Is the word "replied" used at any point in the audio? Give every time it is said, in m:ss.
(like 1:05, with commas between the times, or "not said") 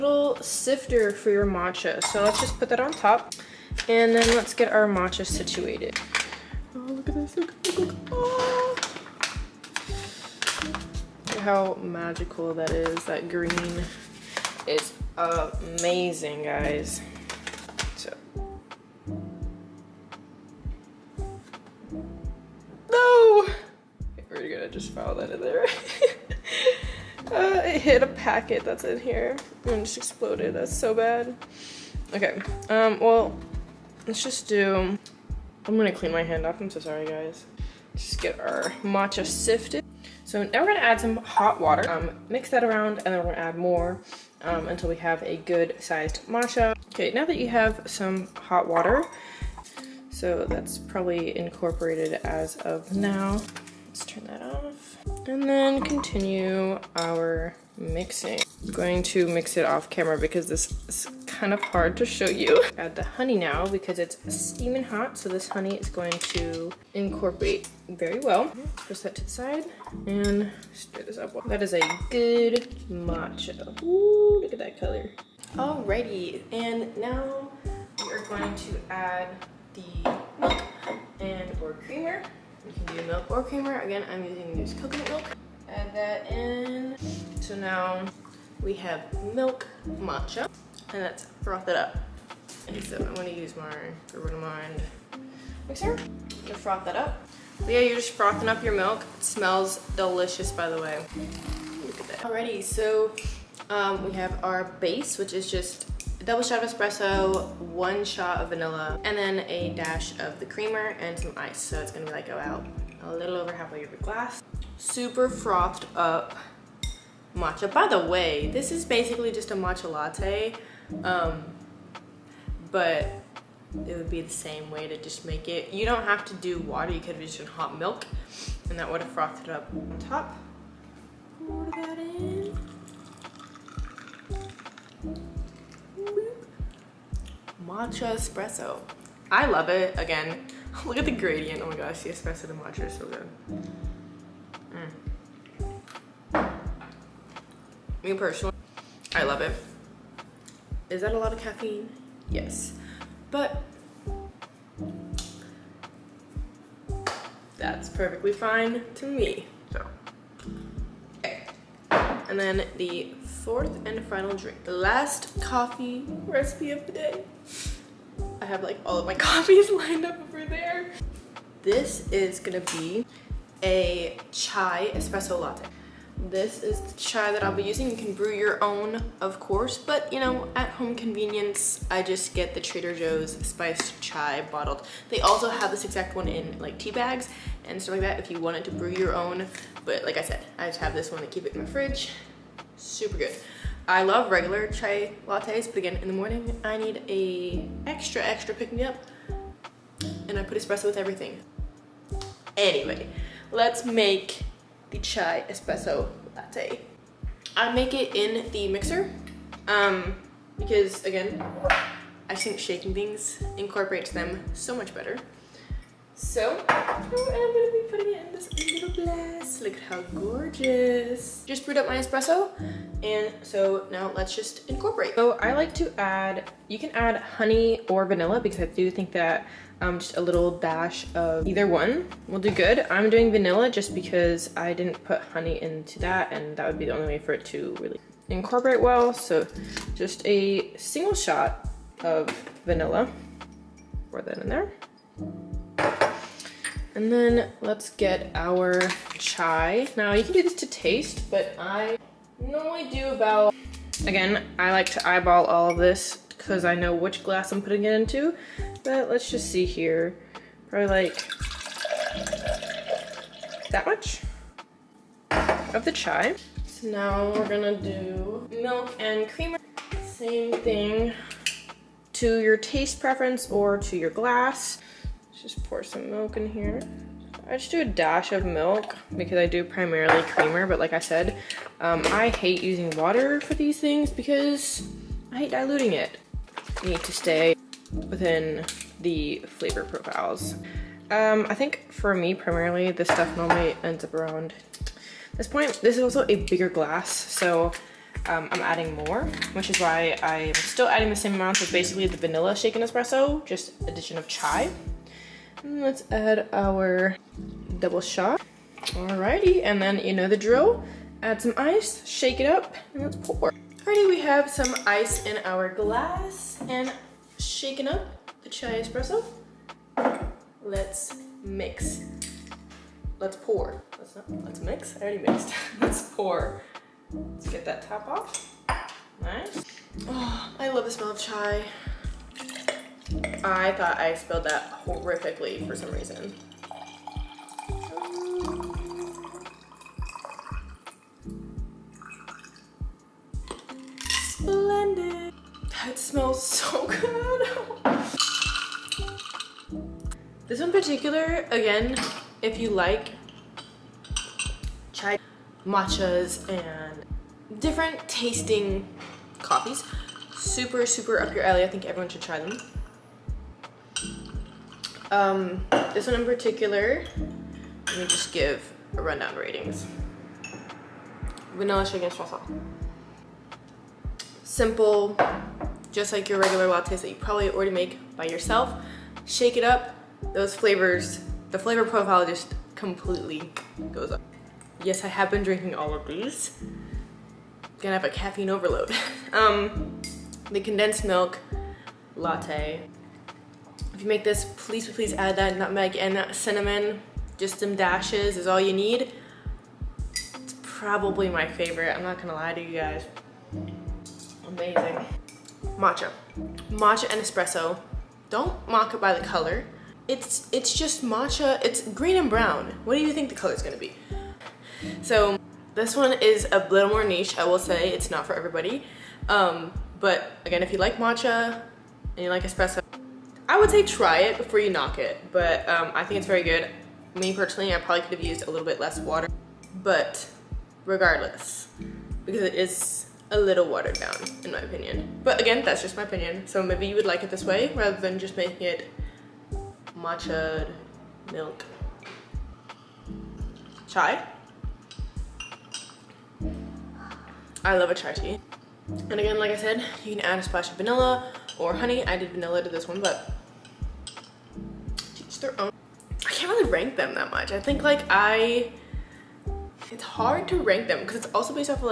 not said.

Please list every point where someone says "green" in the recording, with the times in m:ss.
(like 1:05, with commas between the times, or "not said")
0:13, 6:51.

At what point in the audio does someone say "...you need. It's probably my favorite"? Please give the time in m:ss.
6:38.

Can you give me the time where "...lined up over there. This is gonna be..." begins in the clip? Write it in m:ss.
2:49.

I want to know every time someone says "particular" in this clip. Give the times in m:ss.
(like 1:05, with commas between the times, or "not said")
5:50, 6:06.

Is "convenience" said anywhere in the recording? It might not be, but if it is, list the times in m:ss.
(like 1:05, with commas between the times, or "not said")
3:00.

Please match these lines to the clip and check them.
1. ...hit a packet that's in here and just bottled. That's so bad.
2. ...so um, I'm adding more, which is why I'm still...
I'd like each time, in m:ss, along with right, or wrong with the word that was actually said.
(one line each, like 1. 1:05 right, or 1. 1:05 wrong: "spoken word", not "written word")
1. 0:27 wrong: "exploded", not "bottled"
2. 4:57 right.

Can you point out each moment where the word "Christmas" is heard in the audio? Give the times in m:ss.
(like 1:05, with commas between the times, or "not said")
not said.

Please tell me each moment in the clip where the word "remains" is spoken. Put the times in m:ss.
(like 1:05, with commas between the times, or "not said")
not said.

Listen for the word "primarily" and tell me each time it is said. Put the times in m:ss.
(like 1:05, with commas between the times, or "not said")
4:39, 4:52.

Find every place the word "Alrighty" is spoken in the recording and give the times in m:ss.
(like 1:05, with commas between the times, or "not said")
1:15, 1:42, 5:08, 5:13.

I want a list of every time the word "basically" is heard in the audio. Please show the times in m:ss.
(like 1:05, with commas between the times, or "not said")
1:58, 5:01.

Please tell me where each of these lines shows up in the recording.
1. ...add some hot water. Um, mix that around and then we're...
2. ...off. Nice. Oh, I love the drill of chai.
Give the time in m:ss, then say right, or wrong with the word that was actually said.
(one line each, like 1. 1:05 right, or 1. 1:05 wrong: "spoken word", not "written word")
1. 0:40 right
2. 5:28 wrong: "smell", not "drill".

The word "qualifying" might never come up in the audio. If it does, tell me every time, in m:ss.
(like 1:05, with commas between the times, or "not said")
not said.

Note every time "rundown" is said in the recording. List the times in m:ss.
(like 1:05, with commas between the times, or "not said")
6:09.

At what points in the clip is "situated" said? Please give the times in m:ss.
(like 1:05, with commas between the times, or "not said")
0:05.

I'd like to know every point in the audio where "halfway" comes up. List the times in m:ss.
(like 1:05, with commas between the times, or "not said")
1:53.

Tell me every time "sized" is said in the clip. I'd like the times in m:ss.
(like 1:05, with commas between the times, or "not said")
0:45.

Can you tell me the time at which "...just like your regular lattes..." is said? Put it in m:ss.
6:15.